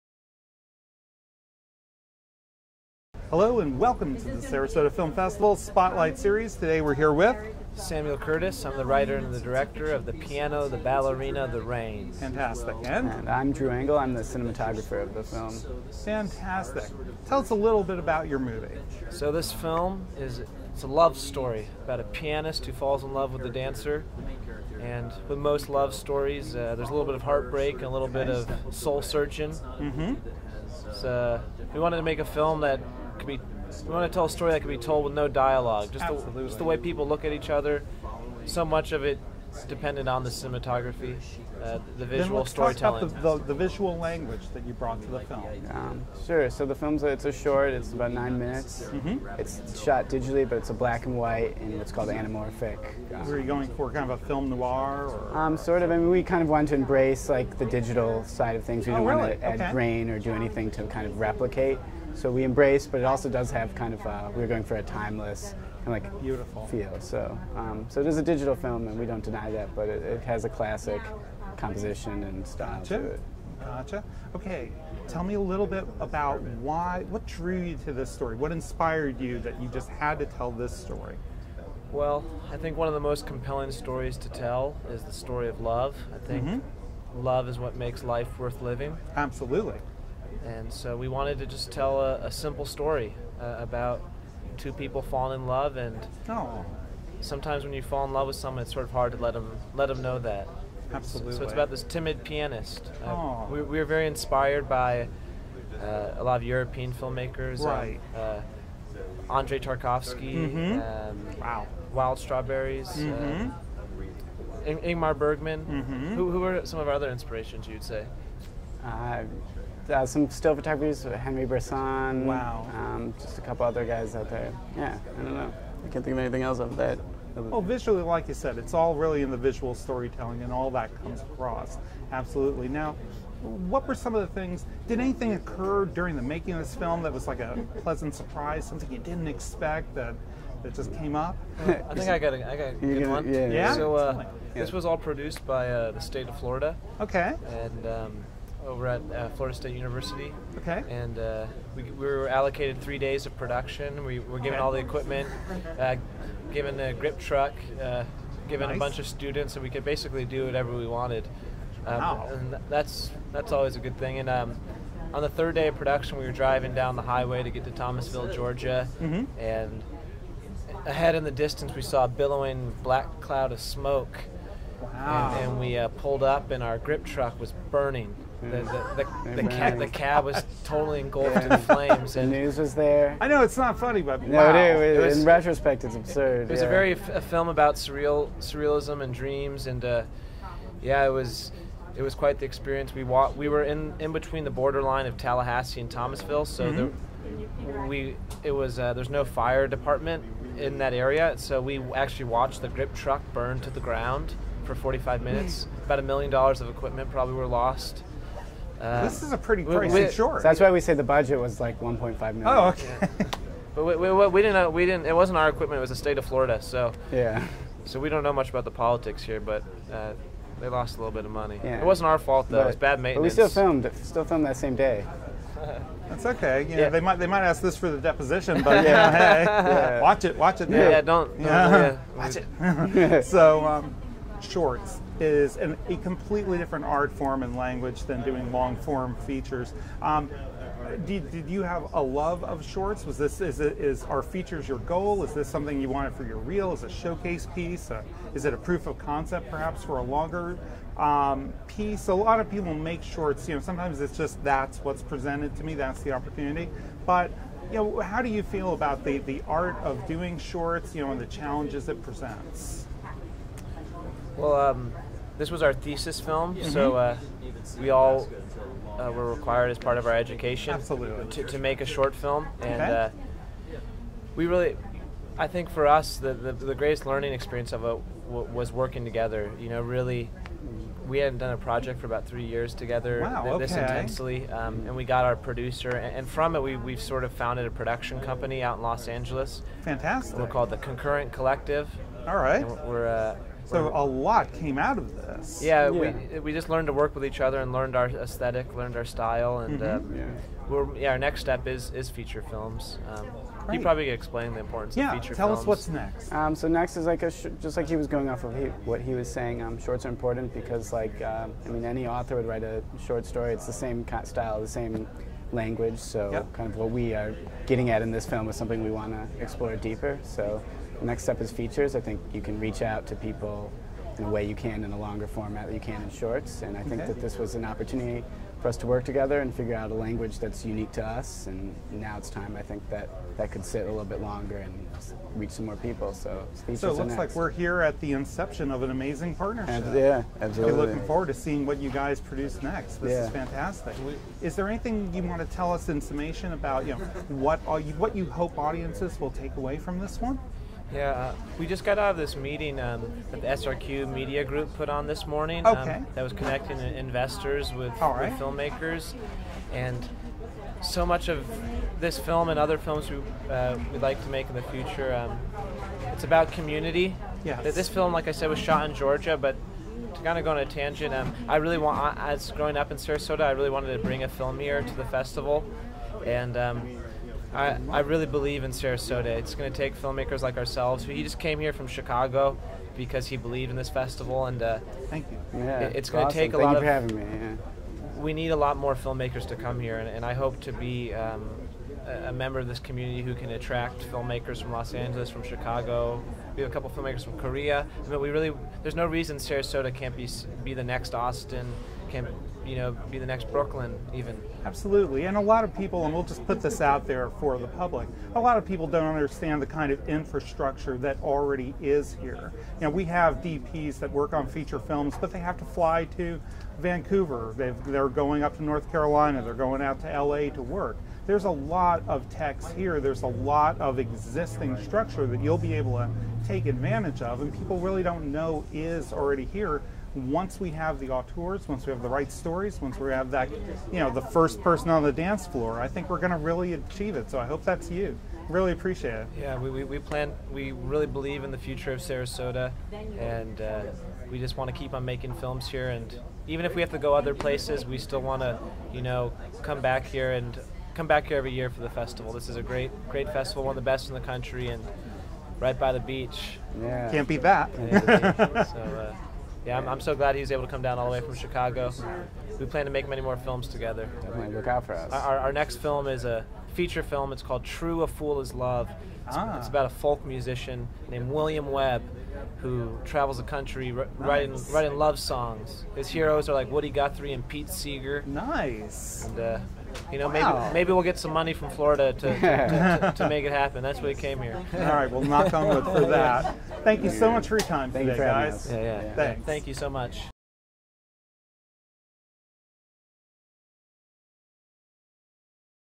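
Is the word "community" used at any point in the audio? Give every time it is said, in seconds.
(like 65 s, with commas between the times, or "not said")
366 s, 392 s.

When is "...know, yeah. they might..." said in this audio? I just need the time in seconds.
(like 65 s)
226 s.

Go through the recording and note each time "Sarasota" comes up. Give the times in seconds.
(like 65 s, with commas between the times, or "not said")
4 s, 372 s, 378 s, 399 s, 442 s.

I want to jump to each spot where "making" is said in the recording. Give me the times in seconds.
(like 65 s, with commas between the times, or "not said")
136 s, 445 s.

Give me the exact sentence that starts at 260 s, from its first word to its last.
You know, and the challenges it presents.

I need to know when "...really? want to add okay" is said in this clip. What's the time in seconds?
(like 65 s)
59 s.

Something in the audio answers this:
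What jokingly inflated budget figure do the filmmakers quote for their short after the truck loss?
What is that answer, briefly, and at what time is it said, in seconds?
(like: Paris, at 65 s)
1.5 million, at 211 s.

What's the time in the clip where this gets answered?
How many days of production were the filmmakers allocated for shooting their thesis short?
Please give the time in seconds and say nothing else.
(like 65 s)
152 s.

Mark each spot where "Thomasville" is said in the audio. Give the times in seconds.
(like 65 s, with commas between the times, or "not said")
167 s, 195 s.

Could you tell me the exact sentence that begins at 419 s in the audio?
They're going out to LA to work.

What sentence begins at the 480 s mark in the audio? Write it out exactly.
maybe maybe we'll get some money from Florida to, to, to, to make it happen.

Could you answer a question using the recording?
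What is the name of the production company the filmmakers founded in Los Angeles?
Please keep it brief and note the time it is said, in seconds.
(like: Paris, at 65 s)
Concurrent Collective, at 290 s.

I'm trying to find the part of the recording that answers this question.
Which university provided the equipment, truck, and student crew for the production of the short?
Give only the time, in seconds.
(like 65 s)
149 s.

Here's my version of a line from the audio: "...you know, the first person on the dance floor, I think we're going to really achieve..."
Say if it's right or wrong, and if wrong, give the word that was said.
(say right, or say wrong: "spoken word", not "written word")
right.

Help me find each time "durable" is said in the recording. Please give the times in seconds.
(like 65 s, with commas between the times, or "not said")
not said.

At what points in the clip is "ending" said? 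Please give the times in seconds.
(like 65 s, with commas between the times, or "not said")
not said.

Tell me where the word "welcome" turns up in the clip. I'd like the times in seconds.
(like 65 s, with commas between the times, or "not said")
3 s.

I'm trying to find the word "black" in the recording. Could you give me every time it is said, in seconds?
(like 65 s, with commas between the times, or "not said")
50 s, 172 s.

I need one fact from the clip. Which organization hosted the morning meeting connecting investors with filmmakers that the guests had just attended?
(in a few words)
SRQ Media Group.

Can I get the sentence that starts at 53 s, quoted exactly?
Um, Were you going for kind of a film noir?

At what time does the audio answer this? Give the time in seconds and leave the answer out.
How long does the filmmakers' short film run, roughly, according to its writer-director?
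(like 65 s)
48 s.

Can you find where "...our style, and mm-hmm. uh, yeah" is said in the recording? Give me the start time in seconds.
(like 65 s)
298 s.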